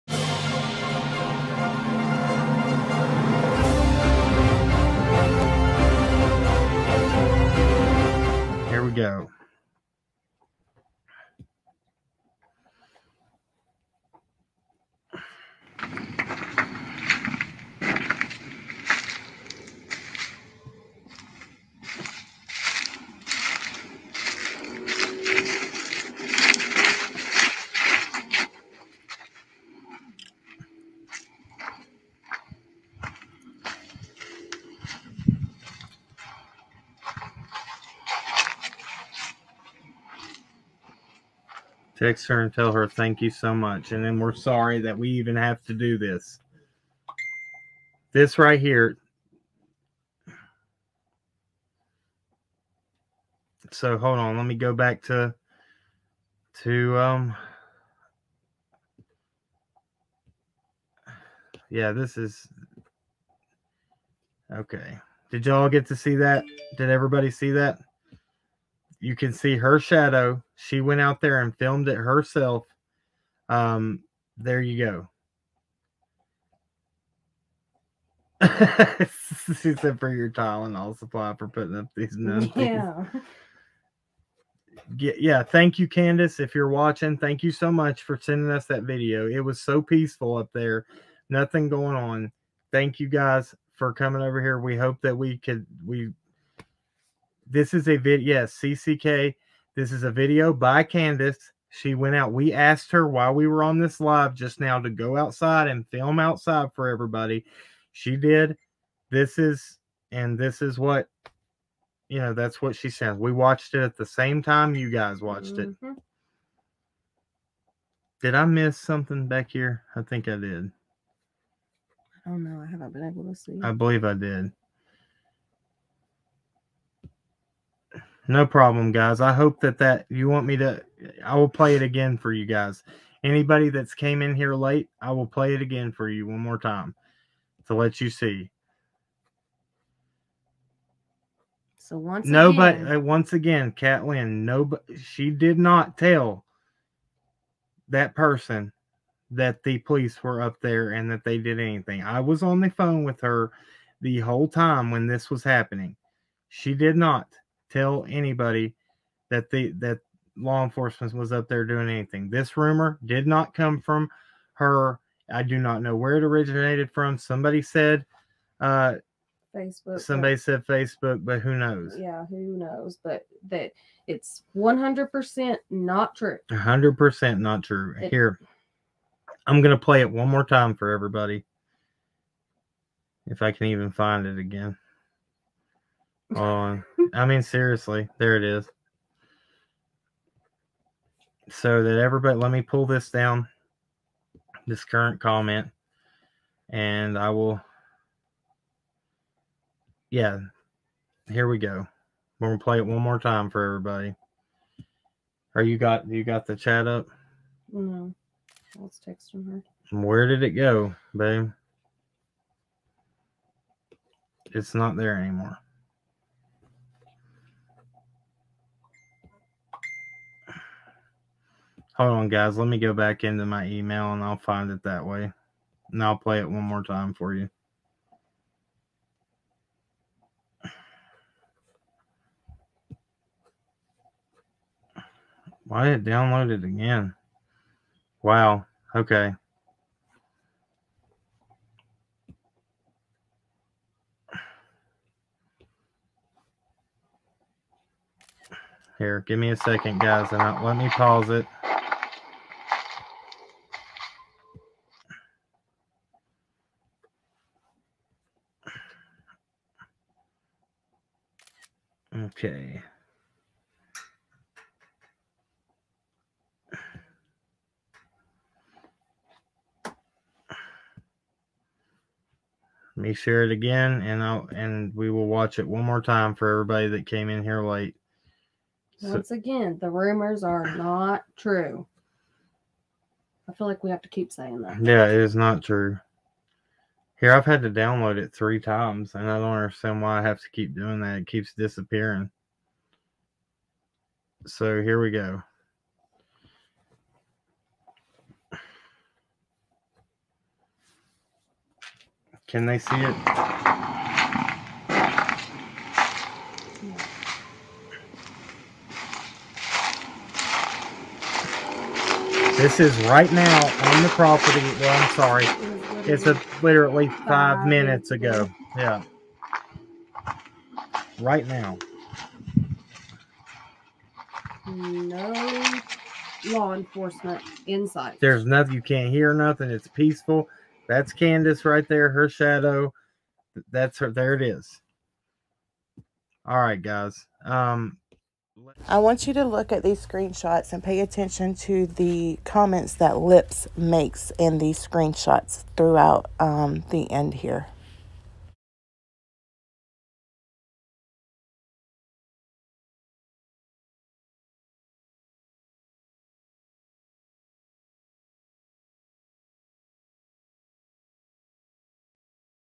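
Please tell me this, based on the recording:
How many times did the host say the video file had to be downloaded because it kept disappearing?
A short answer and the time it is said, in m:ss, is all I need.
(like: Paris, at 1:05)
3 times, at 4:48.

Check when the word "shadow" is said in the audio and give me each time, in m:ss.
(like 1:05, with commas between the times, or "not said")
1:09, 5:32.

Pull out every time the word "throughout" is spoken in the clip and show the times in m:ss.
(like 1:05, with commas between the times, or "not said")
5:45.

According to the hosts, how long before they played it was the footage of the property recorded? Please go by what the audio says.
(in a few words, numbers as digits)
5 minutes.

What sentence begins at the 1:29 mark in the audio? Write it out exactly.
It was so peaceful up there.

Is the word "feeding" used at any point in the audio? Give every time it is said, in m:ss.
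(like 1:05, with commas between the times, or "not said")
not said.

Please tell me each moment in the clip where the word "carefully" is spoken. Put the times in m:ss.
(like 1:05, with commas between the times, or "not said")
not said.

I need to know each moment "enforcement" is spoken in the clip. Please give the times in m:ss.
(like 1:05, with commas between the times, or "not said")
2:40, 5:26.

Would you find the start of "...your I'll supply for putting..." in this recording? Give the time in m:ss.
1:20.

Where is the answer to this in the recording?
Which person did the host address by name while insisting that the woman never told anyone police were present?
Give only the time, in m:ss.
2:23.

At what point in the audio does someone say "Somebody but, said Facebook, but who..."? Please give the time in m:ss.
2:49.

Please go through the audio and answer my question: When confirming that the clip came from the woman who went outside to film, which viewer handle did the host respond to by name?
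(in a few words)
CCK.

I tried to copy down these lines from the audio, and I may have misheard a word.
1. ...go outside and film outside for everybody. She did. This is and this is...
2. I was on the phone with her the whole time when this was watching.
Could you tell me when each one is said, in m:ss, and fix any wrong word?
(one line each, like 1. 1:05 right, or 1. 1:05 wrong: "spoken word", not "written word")
1. 1:44 right
2. 2:32 wrong: "happening", not "watching".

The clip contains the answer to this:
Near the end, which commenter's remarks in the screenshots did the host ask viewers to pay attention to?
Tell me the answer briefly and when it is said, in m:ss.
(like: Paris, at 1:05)
Lips, at 5:43.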